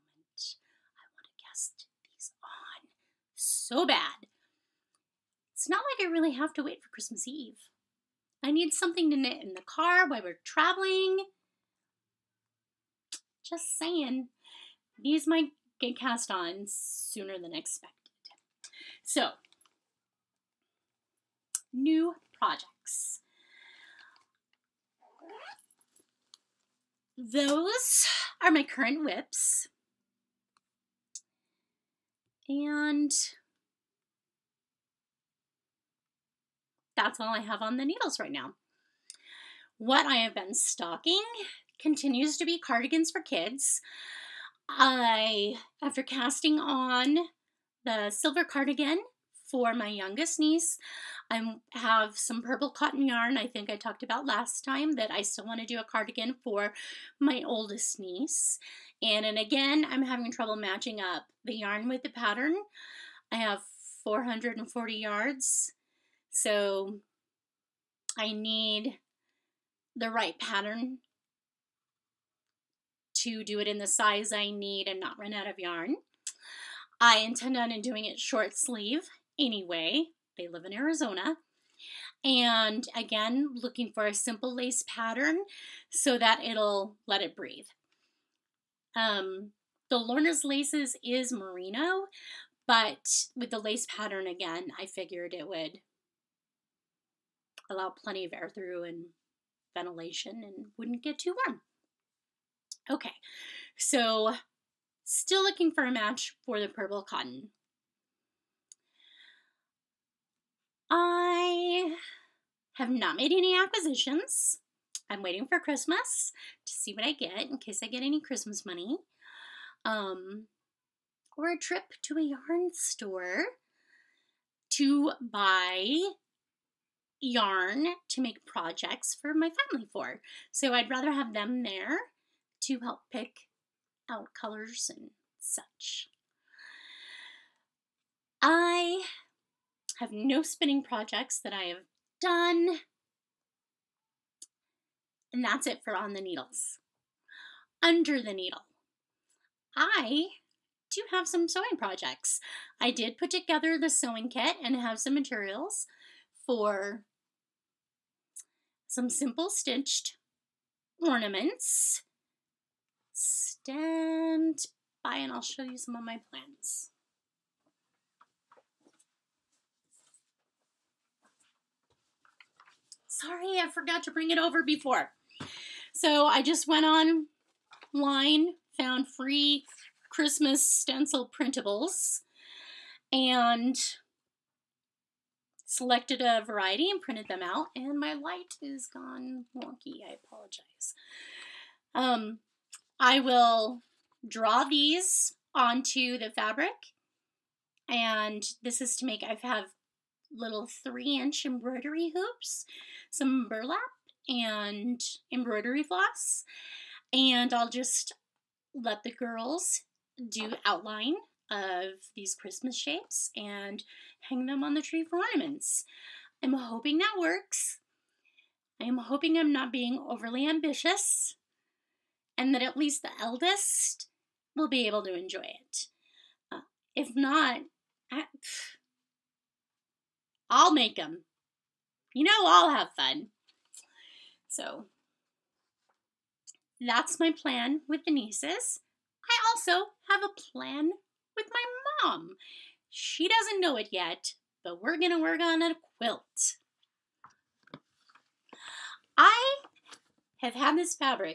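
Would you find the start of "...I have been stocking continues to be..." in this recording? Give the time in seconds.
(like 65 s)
40 s.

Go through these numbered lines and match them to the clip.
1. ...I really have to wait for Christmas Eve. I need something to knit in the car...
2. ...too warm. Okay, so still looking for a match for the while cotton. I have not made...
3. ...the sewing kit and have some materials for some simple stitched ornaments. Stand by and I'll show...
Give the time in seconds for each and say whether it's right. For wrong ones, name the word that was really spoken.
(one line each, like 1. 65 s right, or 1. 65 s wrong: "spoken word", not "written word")
1. 6 s right
2. 101 s wrong: "purple", not "while"
3. 153 s right.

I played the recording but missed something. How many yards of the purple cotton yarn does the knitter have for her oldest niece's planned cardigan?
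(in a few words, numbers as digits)
440.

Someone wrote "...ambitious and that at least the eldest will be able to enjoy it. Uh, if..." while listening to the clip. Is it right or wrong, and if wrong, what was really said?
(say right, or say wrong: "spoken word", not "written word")
right.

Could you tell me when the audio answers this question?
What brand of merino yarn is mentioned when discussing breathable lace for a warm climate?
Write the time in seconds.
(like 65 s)
89 s.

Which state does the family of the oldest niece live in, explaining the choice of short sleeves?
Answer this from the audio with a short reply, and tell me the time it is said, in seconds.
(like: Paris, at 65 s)
Arizona, at 80 s.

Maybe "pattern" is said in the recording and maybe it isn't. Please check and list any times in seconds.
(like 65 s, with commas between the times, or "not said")
62 s, 70 s, 84 s, 93 s.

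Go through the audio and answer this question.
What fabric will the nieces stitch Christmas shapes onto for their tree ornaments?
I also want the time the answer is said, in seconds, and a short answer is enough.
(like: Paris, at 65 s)
burlap, at 203 s.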